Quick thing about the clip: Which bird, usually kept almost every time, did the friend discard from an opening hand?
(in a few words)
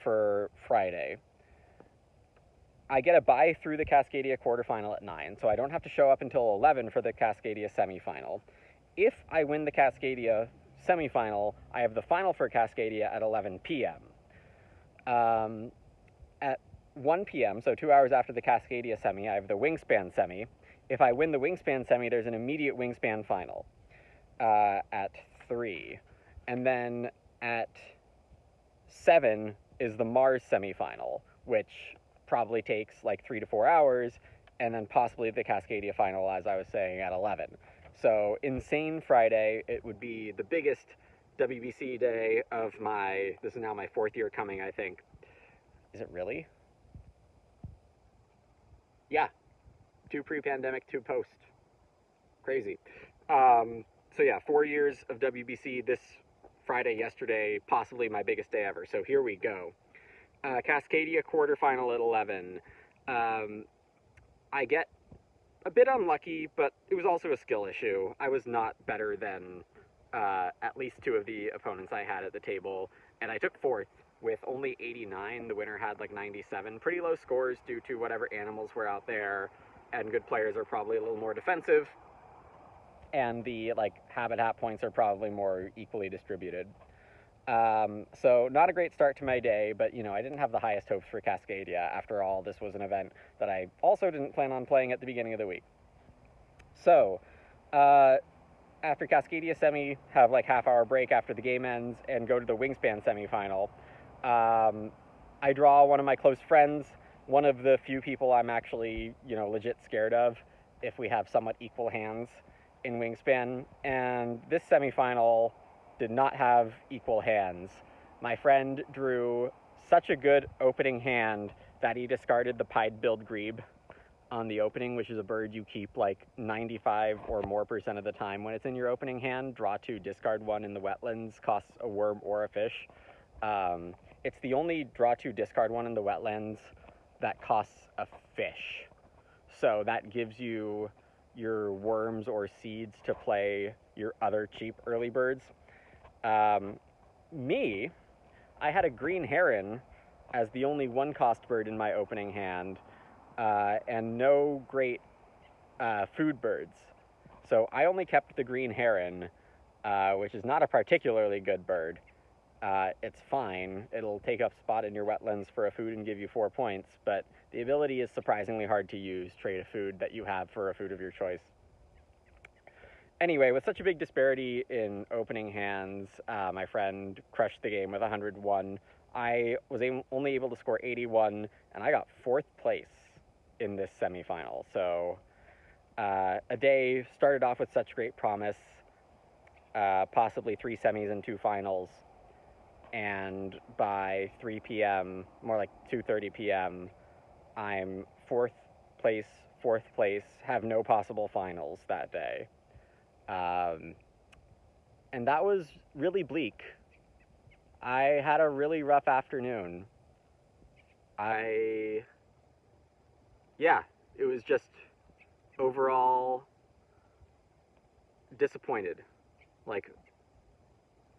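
Pied-billed Grebe.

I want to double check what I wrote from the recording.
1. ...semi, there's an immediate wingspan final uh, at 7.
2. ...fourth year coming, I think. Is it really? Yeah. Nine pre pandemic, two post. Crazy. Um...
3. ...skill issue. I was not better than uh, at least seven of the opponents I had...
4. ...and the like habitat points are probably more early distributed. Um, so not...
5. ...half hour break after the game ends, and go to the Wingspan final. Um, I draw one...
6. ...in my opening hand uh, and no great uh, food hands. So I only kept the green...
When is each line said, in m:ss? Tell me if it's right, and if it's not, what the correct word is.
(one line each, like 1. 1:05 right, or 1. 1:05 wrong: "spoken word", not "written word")
1. 0:21 wrong: "3", not "7"
2. 0:43 wrong: "Two", not "Nine"
3. 1:07 wrong: "two", not "seven"
4. 1:23 wrong: "equally", not "early"
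5. 1:40 wrong: "semifinal", not "final"
6. 2:31 wrong: "birds", not "hands".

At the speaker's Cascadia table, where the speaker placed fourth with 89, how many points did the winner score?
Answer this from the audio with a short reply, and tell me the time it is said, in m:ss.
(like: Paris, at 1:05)
97, at 1:16.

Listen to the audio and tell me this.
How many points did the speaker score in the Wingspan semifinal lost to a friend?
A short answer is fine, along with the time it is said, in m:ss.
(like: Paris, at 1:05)
81, at 3:00.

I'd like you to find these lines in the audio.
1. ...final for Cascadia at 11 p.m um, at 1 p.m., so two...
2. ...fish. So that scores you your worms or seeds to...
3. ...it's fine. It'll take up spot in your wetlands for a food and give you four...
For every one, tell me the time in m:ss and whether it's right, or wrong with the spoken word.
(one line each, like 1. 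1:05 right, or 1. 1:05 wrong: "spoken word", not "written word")
1. 0:12 right
2. 2:18 wrong: "gives", not "scores"
3. 2:43 right.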